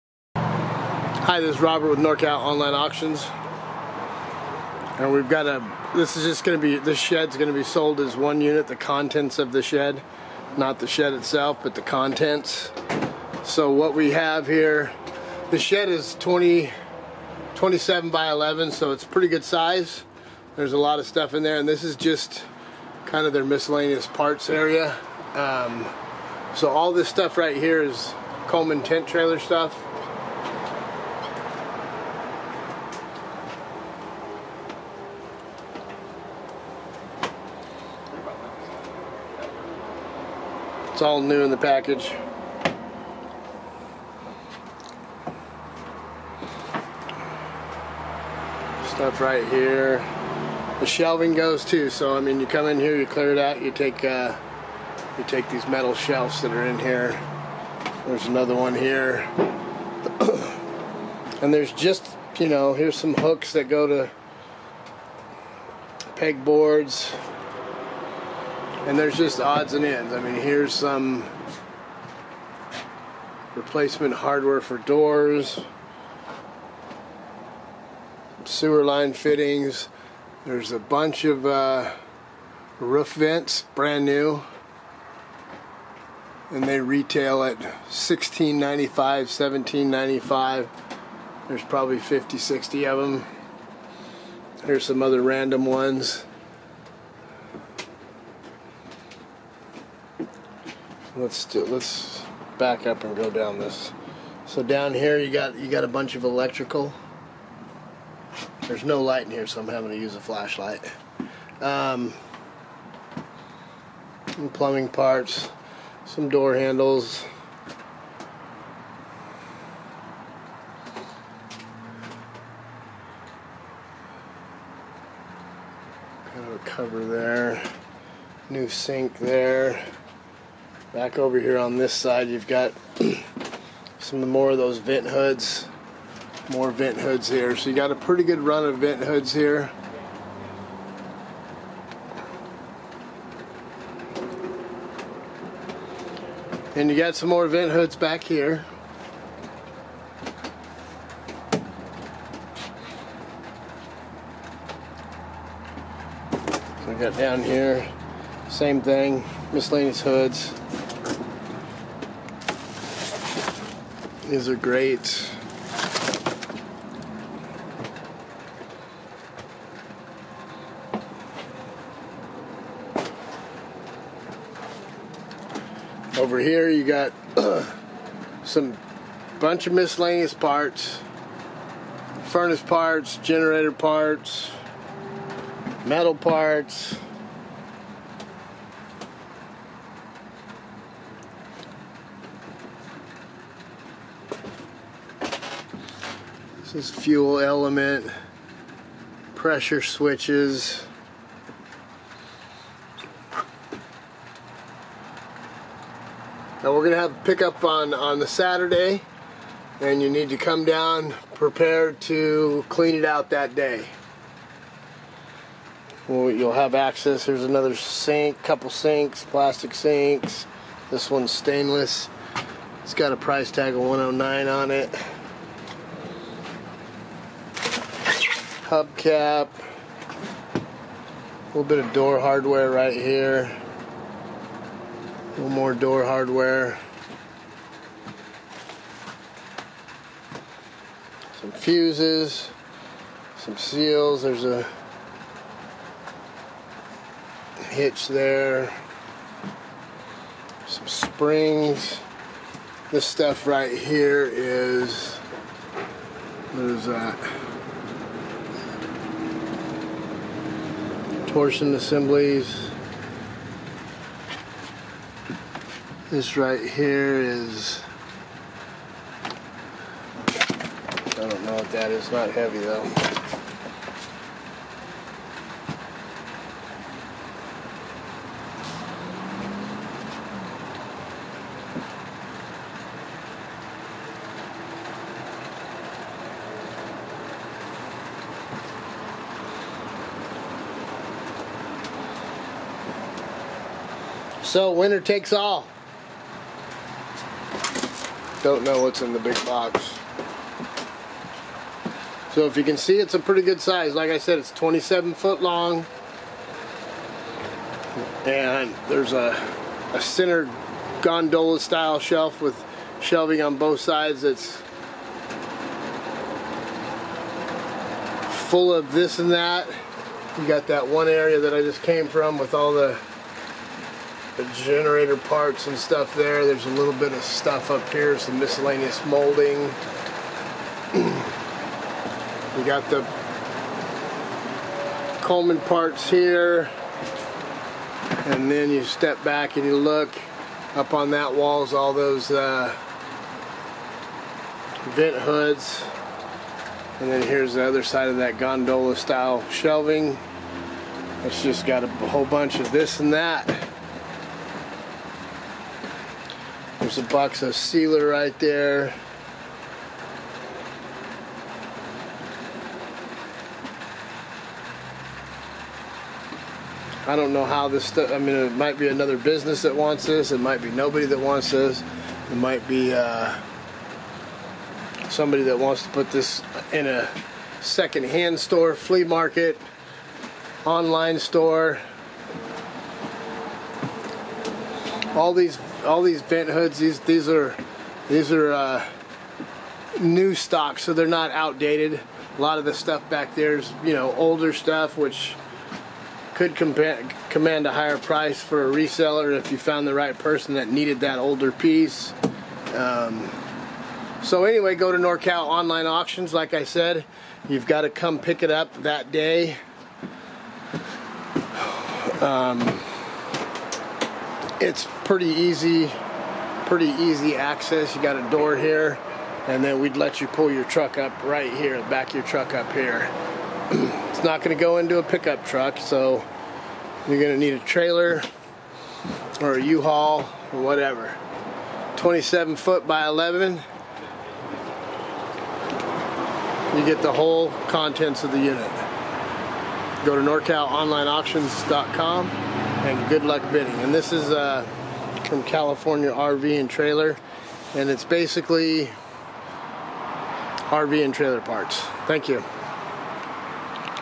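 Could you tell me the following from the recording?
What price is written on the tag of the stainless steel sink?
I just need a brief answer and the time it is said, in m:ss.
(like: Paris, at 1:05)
109, at 3:43.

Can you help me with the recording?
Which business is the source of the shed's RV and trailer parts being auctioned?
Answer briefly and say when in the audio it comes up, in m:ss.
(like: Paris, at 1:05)
California RV and Trailer, at 7:25.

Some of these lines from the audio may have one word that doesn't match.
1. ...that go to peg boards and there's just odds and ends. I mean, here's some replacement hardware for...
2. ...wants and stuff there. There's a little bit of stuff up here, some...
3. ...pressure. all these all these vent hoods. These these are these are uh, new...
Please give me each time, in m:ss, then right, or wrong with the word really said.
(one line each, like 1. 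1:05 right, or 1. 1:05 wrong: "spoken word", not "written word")
1. 1:03 right
2. 5:25 wrong: "parts", not "wants"
3. 6:21 wrong: "store", not "pressure".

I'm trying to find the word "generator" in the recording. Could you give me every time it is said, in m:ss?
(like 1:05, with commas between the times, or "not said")
3:03, 5:24.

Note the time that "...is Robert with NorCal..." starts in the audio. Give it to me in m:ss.
0:01.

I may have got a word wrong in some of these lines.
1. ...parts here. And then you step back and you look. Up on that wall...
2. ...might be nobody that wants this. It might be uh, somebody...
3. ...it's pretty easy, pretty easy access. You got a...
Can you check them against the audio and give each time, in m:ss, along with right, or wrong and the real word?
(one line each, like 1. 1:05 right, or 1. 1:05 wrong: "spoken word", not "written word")
1. 5:35 right
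2. 6:10 right
3. 6:54 right.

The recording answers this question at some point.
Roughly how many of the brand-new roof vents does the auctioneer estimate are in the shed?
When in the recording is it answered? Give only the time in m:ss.
1:31.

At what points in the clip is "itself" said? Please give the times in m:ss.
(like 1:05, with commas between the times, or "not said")
0:11.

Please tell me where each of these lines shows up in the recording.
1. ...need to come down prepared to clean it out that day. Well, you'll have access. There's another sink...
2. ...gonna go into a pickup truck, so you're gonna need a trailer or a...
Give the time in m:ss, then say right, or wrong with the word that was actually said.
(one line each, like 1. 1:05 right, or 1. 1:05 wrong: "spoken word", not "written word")
1. 3:30 right
2. 7:04 right.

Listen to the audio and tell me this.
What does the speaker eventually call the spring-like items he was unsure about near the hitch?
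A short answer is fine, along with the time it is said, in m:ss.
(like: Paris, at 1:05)
torsion assemblies, at 4:21.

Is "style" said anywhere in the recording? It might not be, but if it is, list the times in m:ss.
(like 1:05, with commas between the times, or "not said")
5:11, 5:48.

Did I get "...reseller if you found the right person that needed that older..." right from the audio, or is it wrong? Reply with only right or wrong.
right.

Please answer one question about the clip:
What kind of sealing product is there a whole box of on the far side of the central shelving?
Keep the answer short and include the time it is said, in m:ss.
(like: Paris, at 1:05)
sealer, at 5:57.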